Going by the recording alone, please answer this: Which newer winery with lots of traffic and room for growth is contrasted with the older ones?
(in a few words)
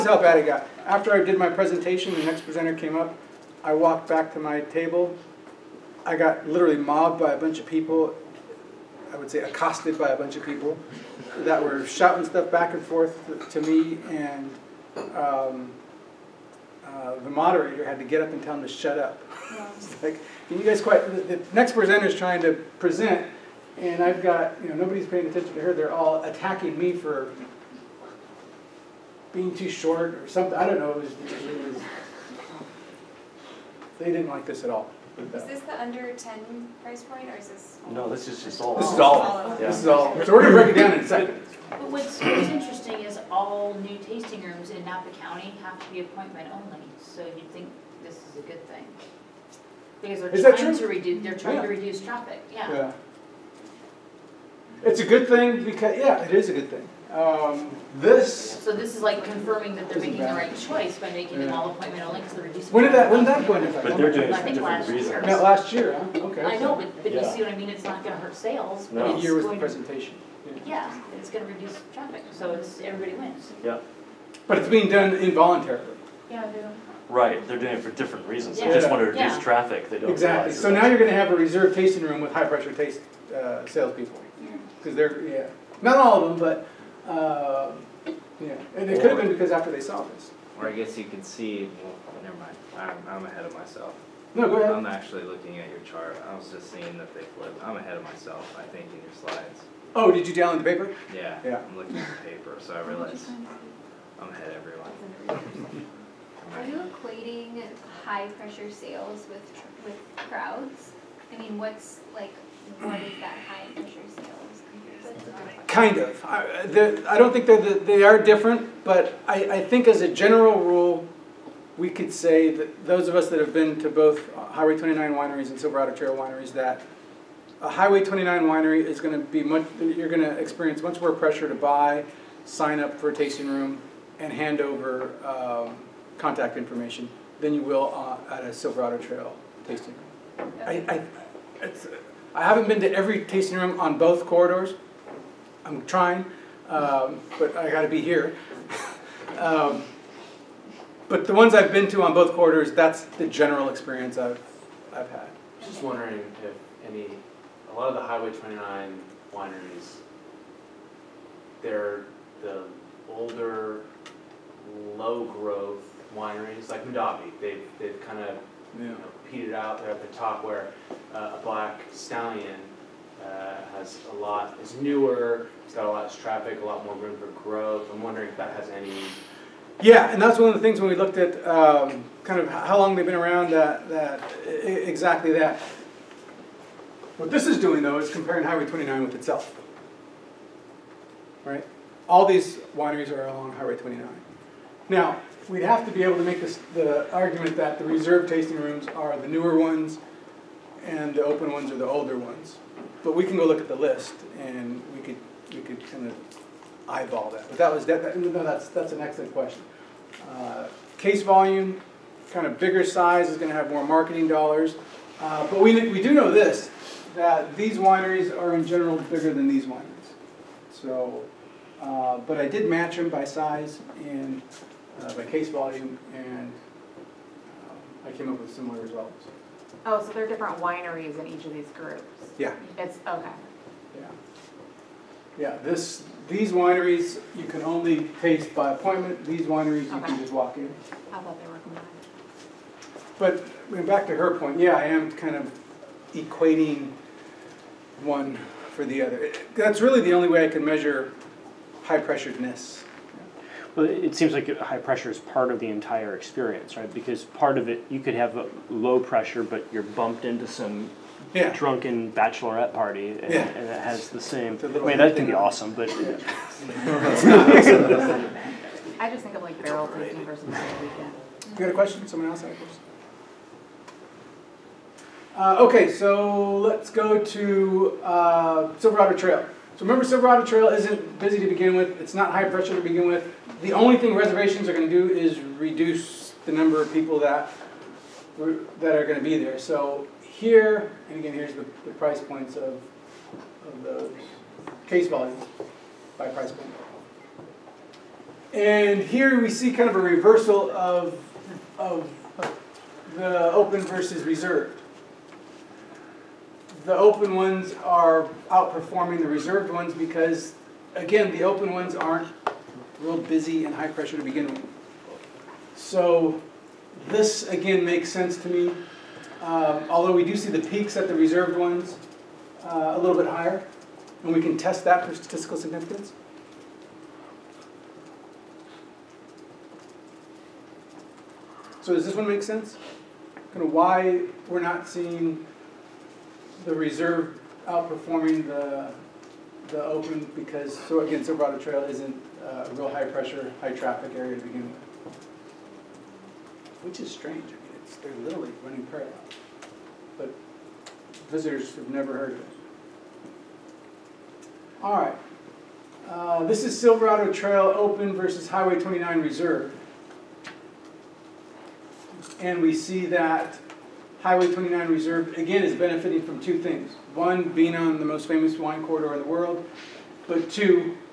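Black Stallion.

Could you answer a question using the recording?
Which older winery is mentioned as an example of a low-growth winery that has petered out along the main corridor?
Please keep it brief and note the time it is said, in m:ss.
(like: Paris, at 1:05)
Mondavi, at 2:46.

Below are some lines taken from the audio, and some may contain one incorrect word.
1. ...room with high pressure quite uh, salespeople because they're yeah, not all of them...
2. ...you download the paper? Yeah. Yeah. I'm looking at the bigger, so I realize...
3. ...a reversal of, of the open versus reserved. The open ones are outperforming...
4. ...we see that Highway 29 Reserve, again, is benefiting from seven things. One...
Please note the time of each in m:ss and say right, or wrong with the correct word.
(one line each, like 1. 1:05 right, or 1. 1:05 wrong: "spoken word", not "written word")
1. 1:22 wrong: "taste", not "quite"
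2. 1:40 wrong: "paper", not "bigger"
3. 4:59 right
4. 6:02 wrong: "two", not "seven".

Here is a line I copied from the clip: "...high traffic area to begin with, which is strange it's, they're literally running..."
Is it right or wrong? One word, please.
right.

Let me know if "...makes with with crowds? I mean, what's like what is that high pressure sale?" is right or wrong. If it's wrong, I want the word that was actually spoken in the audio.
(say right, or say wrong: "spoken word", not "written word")
wrong: "sales", not "makes".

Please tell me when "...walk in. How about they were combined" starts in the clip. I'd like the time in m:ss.
4:00.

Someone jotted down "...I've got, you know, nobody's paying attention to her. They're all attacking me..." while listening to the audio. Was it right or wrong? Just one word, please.
right.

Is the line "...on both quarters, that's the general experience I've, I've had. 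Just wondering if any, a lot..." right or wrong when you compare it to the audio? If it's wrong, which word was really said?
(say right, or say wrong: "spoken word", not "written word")
right.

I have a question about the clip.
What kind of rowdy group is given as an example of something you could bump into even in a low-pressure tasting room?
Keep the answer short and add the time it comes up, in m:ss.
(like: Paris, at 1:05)
Drunken bachelorette party, at 4:21.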